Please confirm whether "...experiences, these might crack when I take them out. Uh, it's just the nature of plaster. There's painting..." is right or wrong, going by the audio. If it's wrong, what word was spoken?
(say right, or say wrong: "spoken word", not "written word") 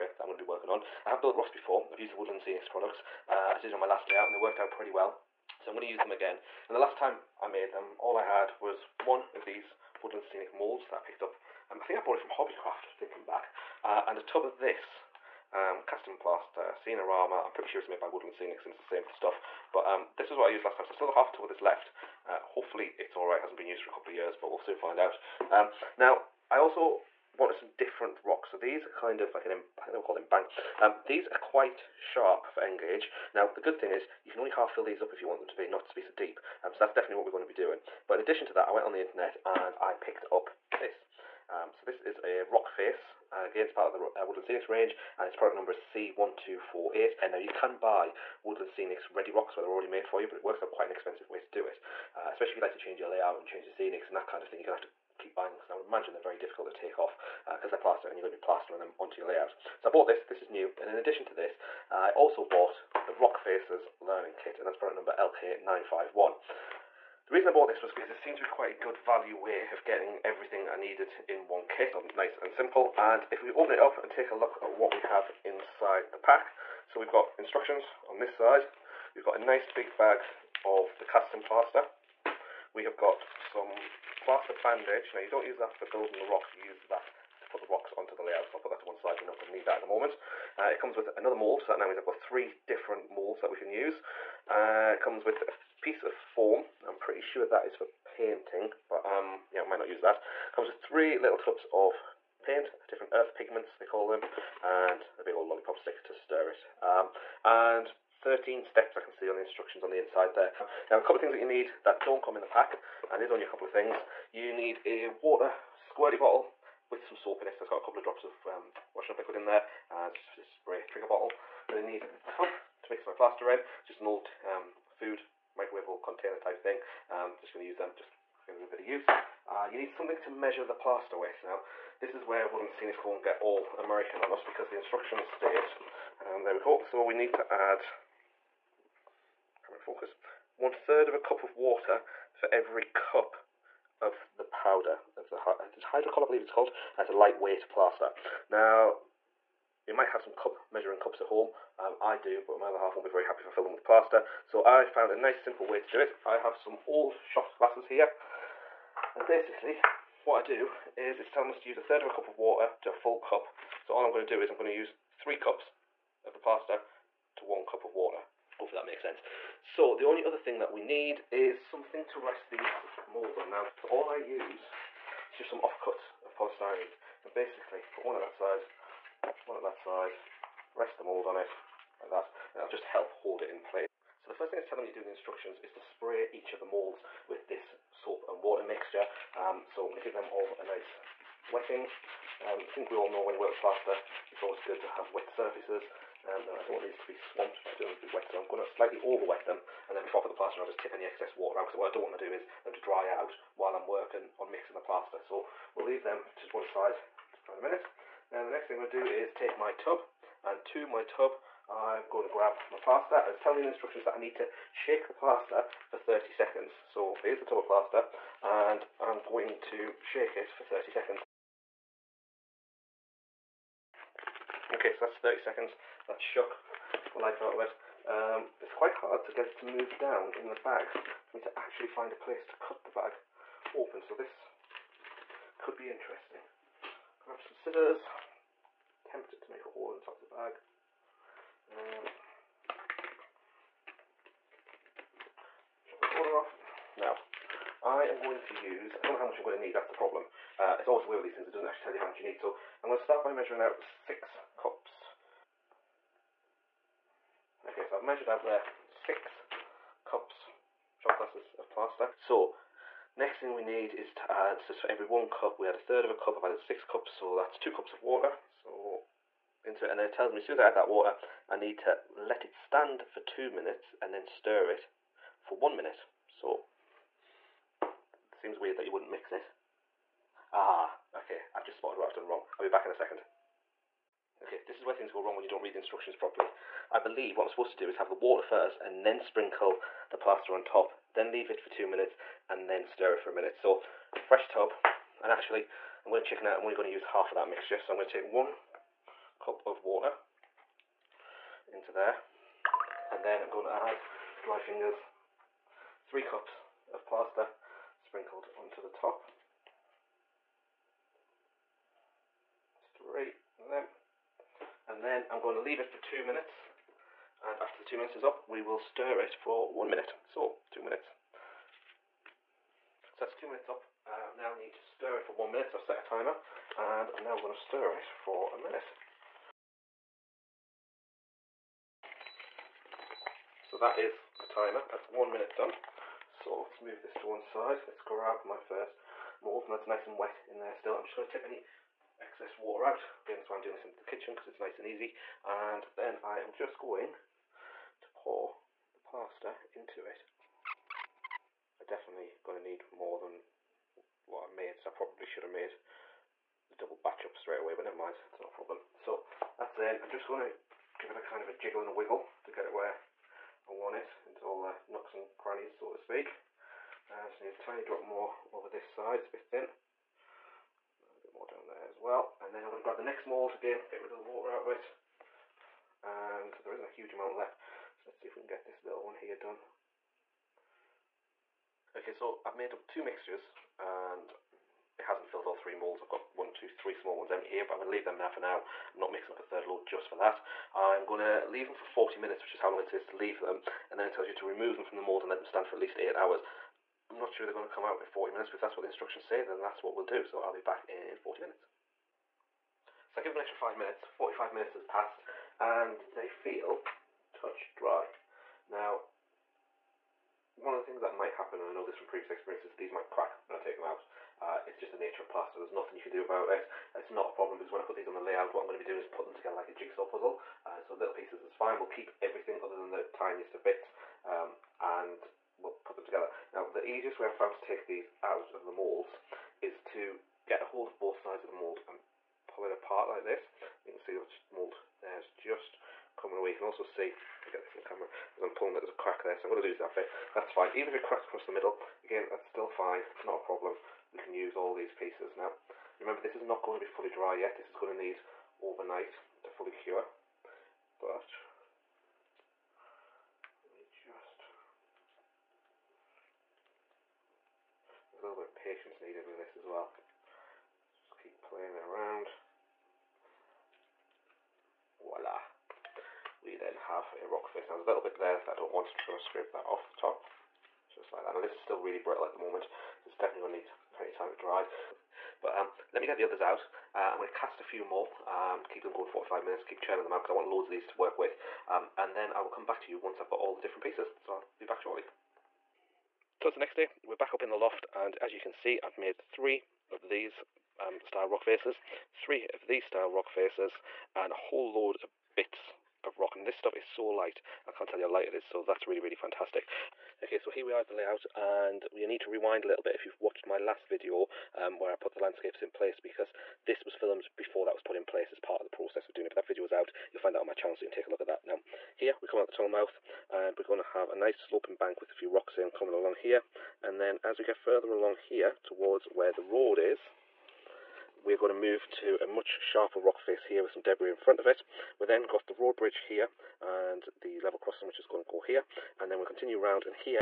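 wrong: "nothing", not "painting".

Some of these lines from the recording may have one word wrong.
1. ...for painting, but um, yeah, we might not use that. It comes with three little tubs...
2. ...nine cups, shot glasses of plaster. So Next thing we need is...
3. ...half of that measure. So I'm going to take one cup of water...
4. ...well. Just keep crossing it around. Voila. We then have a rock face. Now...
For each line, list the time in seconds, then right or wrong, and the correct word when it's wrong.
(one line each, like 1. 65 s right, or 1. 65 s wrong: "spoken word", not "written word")
1. 97 s right
2. 258 s wrong: "six", not "nine"
3. 297 s wrong: "mixture", not "measure"
4. 459 s wrong: "playing", not "crossing".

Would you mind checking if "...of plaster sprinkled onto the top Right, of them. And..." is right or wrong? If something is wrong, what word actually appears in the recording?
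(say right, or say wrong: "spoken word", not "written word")
right.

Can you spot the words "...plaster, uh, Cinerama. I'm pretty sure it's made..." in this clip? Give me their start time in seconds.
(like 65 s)
15 s.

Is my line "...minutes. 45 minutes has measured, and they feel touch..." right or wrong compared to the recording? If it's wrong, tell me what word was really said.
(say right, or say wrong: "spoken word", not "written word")
wrong: "passed", not "measured".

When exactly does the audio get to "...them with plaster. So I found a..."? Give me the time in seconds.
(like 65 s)
153 s.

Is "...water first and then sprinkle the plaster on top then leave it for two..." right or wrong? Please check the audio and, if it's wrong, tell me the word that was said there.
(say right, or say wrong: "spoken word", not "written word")
right.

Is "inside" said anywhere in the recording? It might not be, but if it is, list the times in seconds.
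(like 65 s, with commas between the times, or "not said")
75 s, 109 s.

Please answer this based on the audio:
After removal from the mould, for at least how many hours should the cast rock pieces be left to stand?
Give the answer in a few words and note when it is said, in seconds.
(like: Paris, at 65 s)
8, at 395 s.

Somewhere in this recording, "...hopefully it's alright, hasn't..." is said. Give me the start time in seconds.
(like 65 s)
22 s.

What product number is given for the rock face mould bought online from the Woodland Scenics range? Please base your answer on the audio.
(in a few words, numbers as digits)
C1248.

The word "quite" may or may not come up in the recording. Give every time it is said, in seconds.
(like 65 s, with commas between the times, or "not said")
31 s, 50 s, 68 s, 228 s.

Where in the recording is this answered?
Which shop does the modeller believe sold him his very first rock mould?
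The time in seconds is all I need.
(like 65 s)
12 s.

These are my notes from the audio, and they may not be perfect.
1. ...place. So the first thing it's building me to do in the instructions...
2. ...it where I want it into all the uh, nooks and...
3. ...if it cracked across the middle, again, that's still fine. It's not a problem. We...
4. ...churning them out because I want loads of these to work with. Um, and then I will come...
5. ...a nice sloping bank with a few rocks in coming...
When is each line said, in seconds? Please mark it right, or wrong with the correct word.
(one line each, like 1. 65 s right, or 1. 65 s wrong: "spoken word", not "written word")
1. 183 s wrong: "telling", not "building"
2. 362 s right
3. 440 s right
4. 479 s right
5. 514 s right.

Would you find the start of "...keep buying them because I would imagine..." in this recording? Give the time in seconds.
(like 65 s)
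55 s.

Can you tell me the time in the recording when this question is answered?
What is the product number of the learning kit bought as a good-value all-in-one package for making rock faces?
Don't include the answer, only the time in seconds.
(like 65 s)
65 s.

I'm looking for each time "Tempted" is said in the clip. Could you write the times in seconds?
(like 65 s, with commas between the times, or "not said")
239 s.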